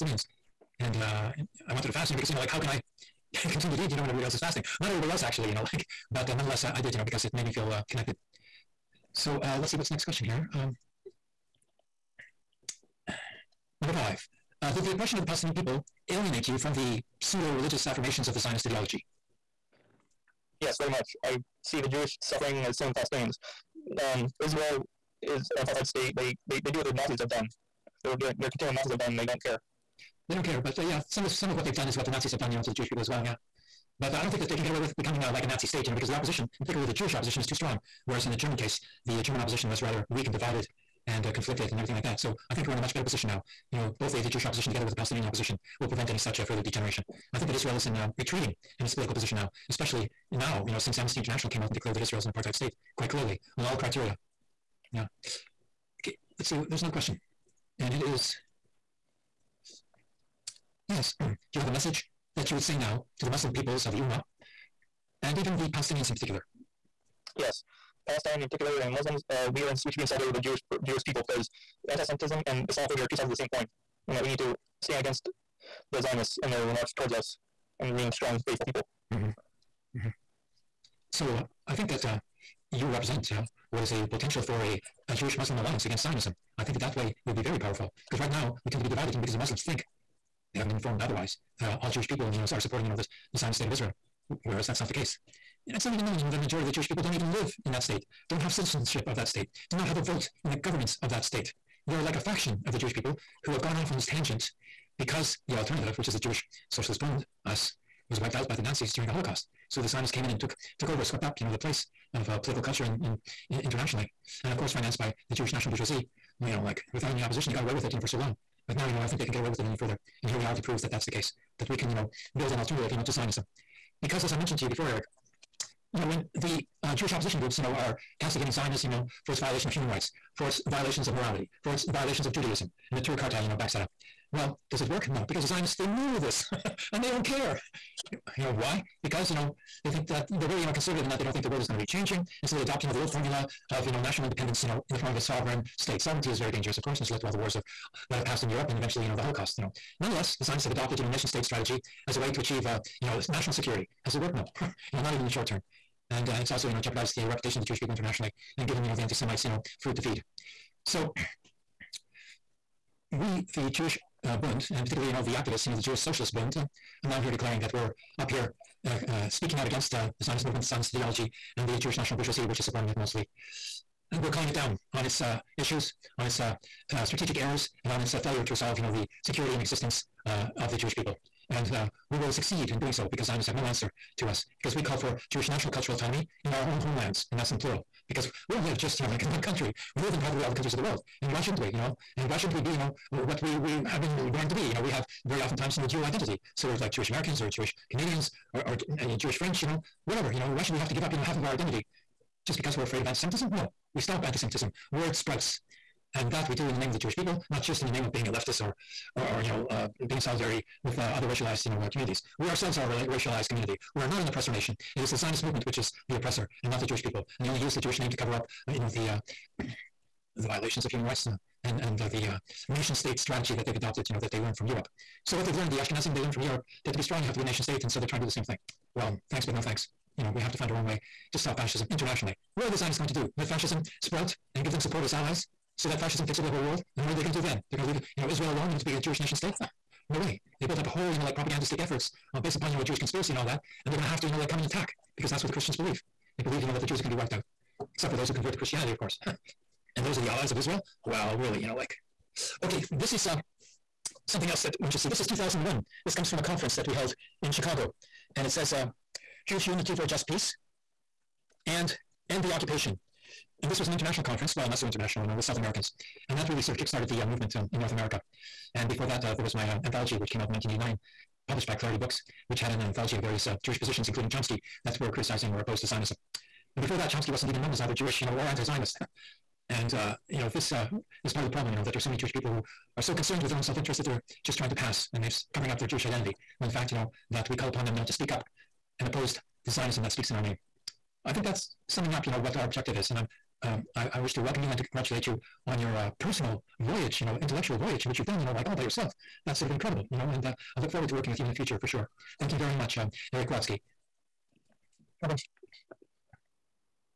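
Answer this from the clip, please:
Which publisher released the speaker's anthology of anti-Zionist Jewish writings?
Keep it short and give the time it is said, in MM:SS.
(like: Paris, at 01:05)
Clarity Books, at 04:31.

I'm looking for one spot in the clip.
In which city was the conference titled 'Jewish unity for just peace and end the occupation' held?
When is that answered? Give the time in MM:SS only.
04:17.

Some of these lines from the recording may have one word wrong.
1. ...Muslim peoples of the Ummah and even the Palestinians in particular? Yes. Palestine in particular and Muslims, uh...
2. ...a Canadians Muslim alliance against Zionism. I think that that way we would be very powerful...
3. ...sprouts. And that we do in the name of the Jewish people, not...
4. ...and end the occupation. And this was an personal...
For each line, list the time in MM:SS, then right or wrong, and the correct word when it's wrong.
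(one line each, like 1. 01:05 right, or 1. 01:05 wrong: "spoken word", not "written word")
1. 01:03 right
2. 01:25 wrong: "Jewish", not "Canadians"
3. 03:25 right
4. 04:21 wrong: "international", not "personal".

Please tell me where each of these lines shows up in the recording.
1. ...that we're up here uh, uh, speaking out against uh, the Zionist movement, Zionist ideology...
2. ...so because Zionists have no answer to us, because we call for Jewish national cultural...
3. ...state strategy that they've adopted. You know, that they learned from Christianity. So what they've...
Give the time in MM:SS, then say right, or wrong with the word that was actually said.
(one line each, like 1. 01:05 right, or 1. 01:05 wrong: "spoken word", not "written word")
1. 02:47 right
2. 03:02 right
3. 03:42 wrong: "Europe", not "Christianity".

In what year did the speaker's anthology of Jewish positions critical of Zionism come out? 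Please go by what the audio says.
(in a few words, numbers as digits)
1989.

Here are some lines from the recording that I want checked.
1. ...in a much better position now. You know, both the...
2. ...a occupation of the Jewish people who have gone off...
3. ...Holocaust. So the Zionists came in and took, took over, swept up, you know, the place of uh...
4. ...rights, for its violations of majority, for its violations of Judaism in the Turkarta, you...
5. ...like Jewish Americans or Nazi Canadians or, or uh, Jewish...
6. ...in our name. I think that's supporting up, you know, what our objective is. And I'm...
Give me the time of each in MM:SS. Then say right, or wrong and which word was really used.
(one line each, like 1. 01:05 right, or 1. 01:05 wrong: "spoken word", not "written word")
1. 00:42 right
2. 01:42 wrong: "faction", not "occupation"
3. 01:49 right
4. 02:09 wrong: "morality", not "majority"
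5. 03:16 wrong: "Jewish", not "Nazi"
6. 04:50 wrong: "summing", not "supporting".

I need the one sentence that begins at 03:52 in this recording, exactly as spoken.
What are the Zionists going to do?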